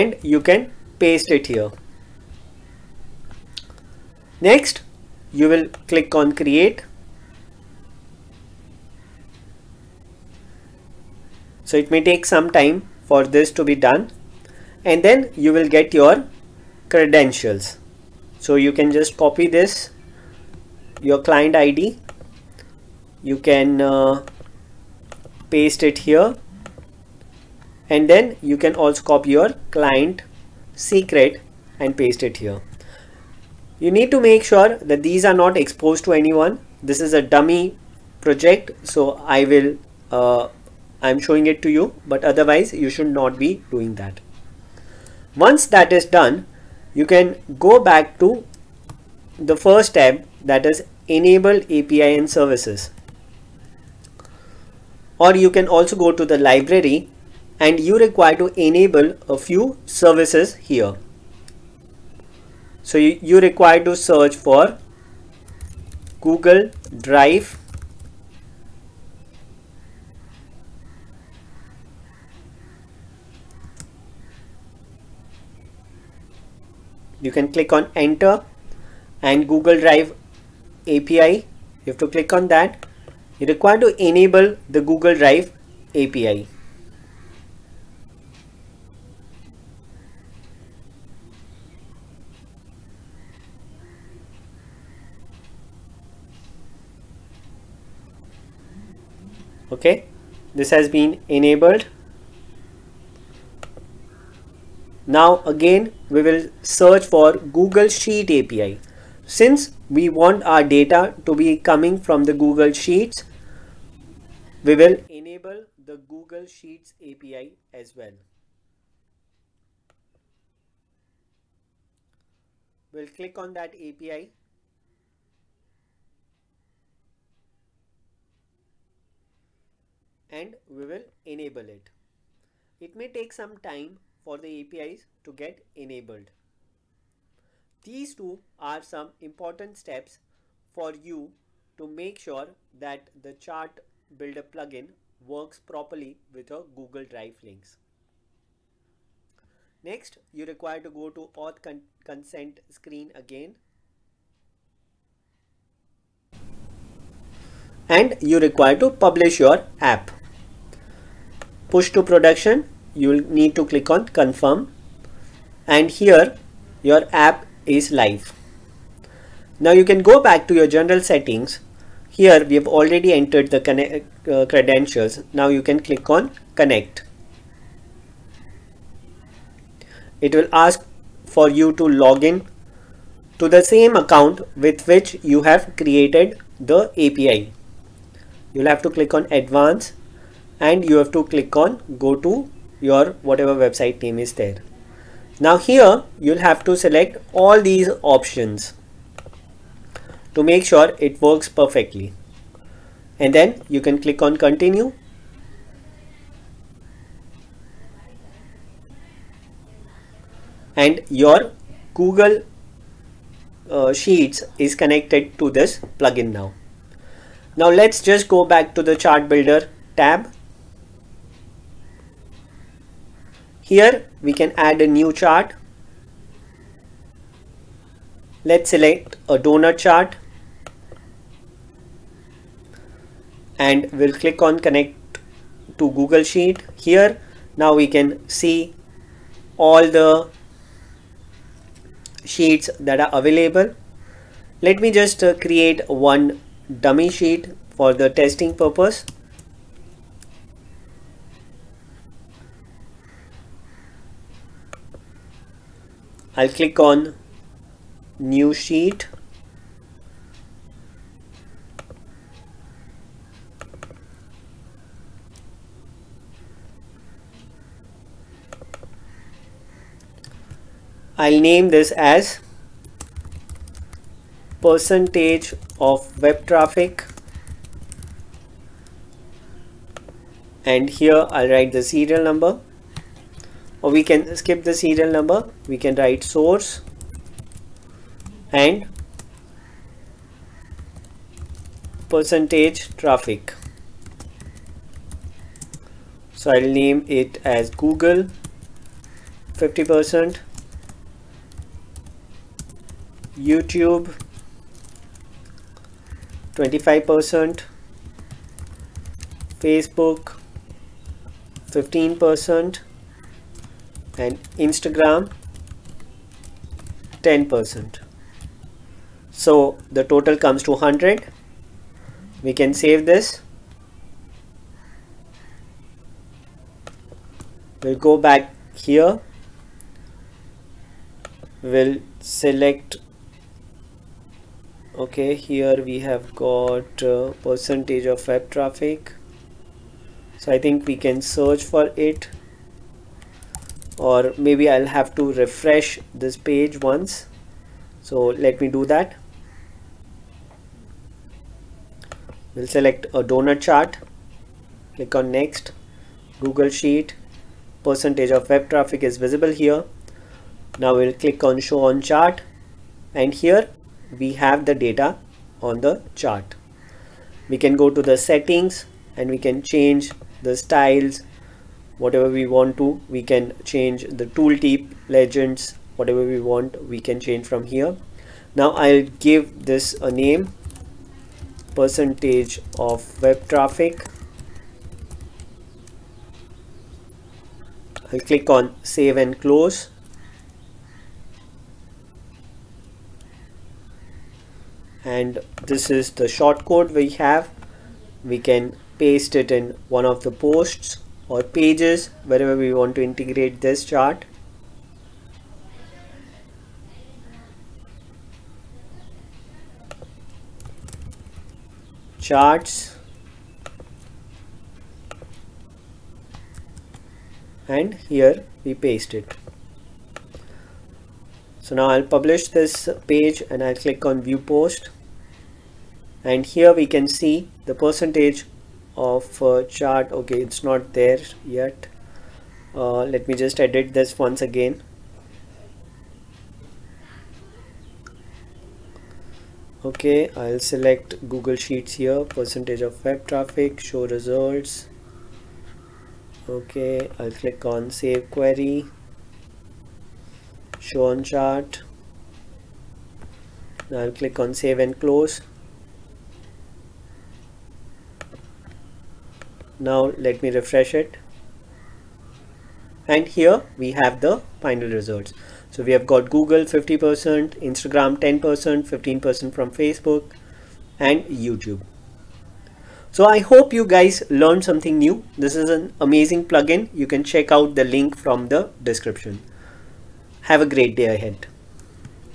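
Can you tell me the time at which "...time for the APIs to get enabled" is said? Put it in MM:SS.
02:13.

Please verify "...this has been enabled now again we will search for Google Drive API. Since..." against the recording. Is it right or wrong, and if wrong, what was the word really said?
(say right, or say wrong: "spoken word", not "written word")
wrong: "Sheet", not "Drive".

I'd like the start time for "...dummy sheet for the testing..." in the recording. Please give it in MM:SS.
04:06.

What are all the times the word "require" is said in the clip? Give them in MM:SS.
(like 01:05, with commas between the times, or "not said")
00:57, 01:03, 01:23, 02:30, 02:38.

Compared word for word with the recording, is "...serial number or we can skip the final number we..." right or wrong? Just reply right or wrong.
wrong.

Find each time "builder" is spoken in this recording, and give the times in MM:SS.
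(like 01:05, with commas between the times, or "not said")
02:24, 03:39.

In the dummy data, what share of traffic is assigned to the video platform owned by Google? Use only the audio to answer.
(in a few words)
25%.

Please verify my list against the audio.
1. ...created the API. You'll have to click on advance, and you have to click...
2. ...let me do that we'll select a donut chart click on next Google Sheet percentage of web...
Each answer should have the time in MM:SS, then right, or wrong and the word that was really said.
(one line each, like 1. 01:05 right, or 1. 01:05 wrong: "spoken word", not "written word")
1. 03:05 right
2. 05:48 right.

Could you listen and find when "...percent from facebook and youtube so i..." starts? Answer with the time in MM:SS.
07:49.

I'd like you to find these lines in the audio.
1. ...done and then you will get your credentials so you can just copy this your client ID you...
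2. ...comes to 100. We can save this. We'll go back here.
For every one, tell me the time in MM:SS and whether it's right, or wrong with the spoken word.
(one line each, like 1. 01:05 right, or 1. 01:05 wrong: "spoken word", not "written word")
1. 00:13 right
2. 05:20 right.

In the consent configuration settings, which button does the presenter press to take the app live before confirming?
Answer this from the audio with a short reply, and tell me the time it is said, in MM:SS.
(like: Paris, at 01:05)
Push to production, at 02:41.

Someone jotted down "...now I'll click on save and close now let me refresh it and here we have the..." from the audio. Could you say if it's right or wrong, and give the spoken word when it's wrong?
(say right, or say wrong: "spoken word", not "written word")
right.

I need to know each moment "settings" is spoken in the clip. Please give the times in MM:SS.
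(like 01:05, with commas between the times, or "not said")
02:51, 06:08.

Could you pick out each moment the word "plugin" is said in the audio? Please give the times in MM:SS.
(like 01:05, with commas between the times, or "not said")
02:24, 03:35, 07:56.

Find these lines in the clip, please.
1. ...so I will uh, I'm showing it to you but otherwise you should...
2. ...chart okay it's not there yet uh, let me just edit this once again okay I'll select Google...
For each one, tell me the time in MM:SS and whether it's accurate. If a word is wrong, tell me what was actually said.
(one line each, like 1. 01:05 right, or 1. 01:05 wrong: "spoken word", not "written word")
1. 00:38 right
2. 07:09 right.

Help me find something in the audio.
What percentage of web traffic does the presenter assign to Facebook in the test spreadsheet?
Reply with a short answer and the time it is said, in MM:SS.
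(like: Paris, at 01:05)
15%, at 05:09.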